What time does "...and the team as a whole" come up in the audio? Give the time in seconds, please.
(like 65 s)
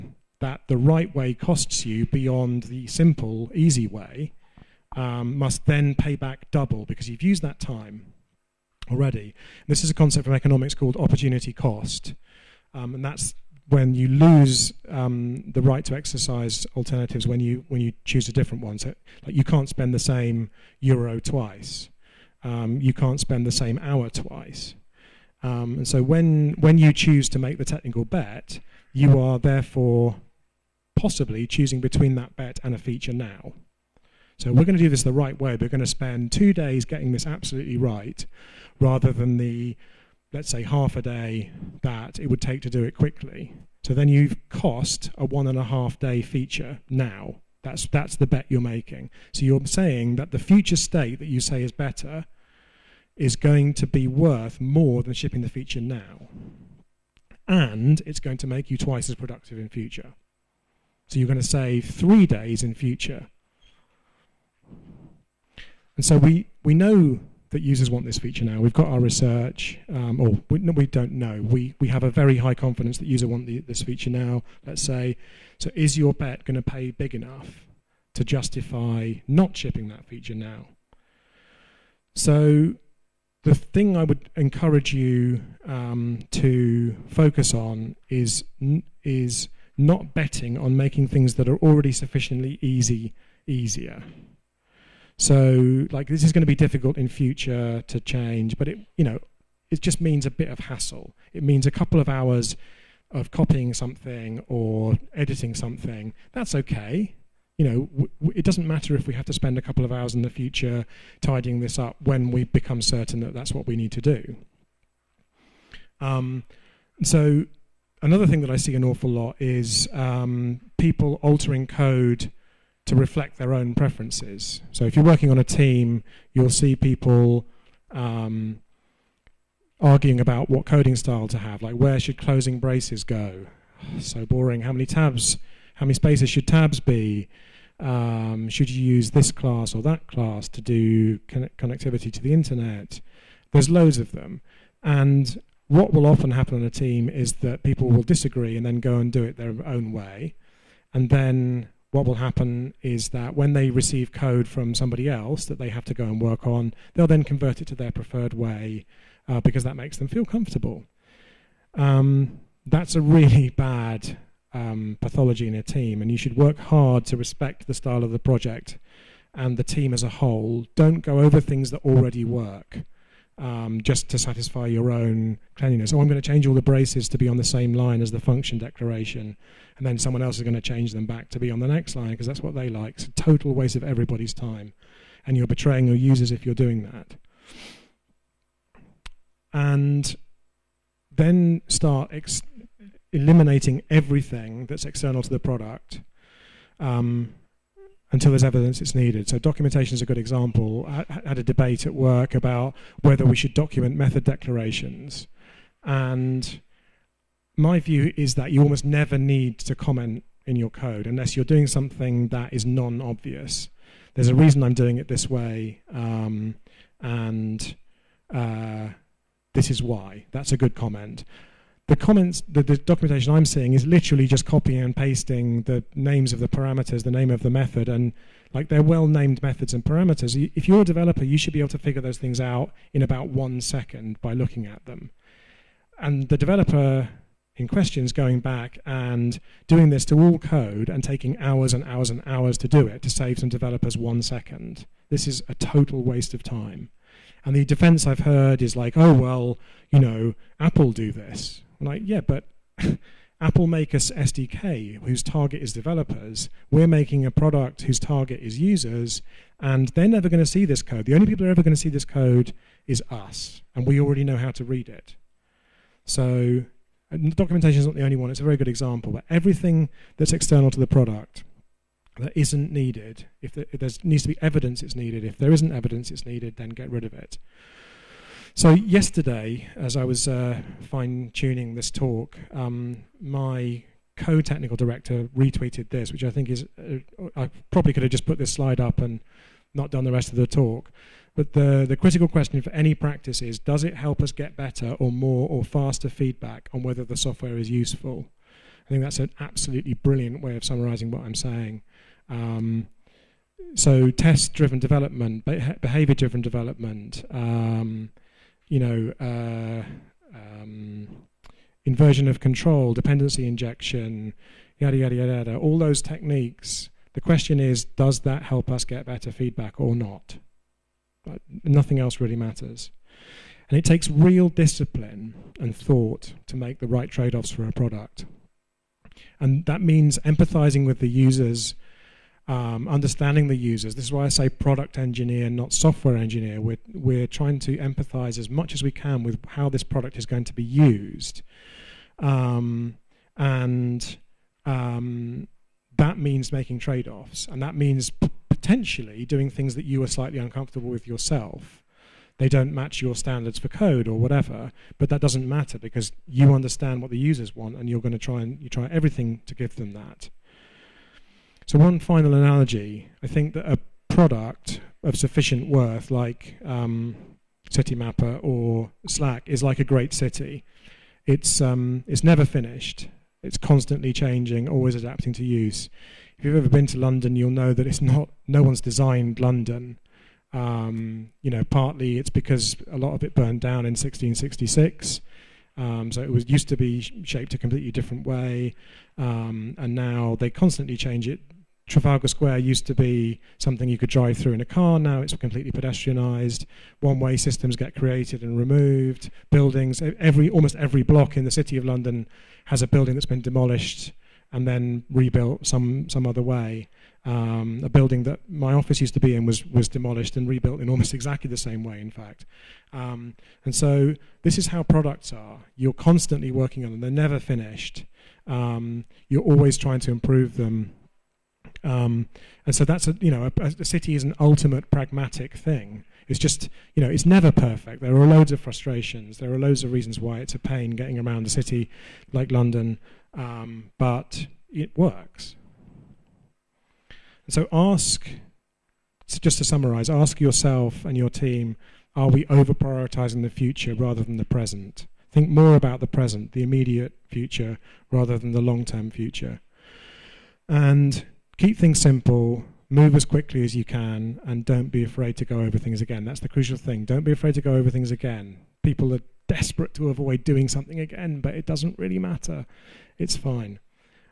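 169 s.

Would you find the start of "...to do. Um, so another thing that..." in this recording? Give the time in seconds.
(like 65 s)
113 s.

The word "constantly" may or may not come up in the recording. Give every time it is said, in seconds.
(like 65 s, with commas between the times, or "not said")
373 s, 390 s, 416 s.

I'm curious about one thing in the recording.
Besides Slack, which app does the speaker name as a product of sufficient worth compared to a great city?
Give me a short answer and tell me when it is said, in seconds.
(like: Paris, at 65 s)
Citymapper, at 367 s.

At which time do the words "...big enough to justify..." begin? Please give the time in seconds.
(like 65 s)
76 s.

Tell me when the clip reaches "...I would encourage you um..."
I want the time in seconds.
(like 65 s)
83 s.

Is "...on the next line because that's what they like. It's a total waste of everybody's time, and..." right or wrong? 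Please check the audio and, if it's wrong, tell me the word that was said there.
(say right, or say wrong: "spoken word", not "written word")
right.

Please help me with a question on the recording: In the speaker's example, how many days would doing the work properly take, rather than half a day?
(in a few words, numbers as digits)
2.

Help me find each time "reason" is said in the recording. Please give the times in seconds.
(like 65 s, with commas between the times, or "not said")
214 s, 429 s.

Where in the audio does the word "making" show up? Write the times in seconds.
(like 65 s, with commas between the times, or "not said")
48 s, 90 s, 256 s, 346 s.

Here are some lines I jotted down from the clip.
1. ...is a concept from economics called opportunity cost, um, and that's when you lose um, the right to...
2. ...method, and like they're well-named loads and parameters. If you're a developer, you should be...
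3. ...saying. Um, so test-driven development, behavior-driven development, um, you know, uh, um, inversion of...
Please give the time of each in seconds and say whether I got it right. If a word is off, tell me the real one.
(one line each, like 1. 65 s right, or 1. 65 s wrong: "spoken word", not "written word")
1. 9 s right
2. 227 s wrong: "methods", not "loads"
3. 301 s right.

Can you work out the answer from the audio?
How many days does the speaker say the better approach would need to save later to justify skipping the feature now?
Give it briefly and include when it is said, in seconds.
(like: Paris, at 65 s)
3, at 61 s.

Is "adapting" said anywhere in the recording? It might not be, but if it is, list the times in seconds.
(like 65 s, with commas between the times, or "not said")
374 s.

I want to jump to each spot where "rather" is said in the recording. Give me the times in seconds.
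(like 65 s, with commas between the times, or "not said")
38 s, 443 s, 448 s.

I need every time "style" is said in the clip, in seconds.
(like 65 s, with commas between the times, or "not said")
130 s, 167 s.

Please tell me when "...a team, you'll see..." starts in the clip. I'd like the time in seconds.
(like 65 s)
125 s.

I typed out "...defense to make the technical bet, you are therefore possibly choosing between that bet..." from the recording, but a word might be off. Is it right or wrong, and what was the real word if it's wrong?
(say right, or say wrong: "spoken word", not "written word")
wrong: "choose", not "defense".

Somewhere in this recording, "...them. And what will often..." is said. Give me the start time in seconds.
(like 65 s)
144 s.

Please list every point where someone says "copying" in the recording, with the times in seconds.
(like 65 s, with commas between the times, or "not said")
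103 s, 224 s.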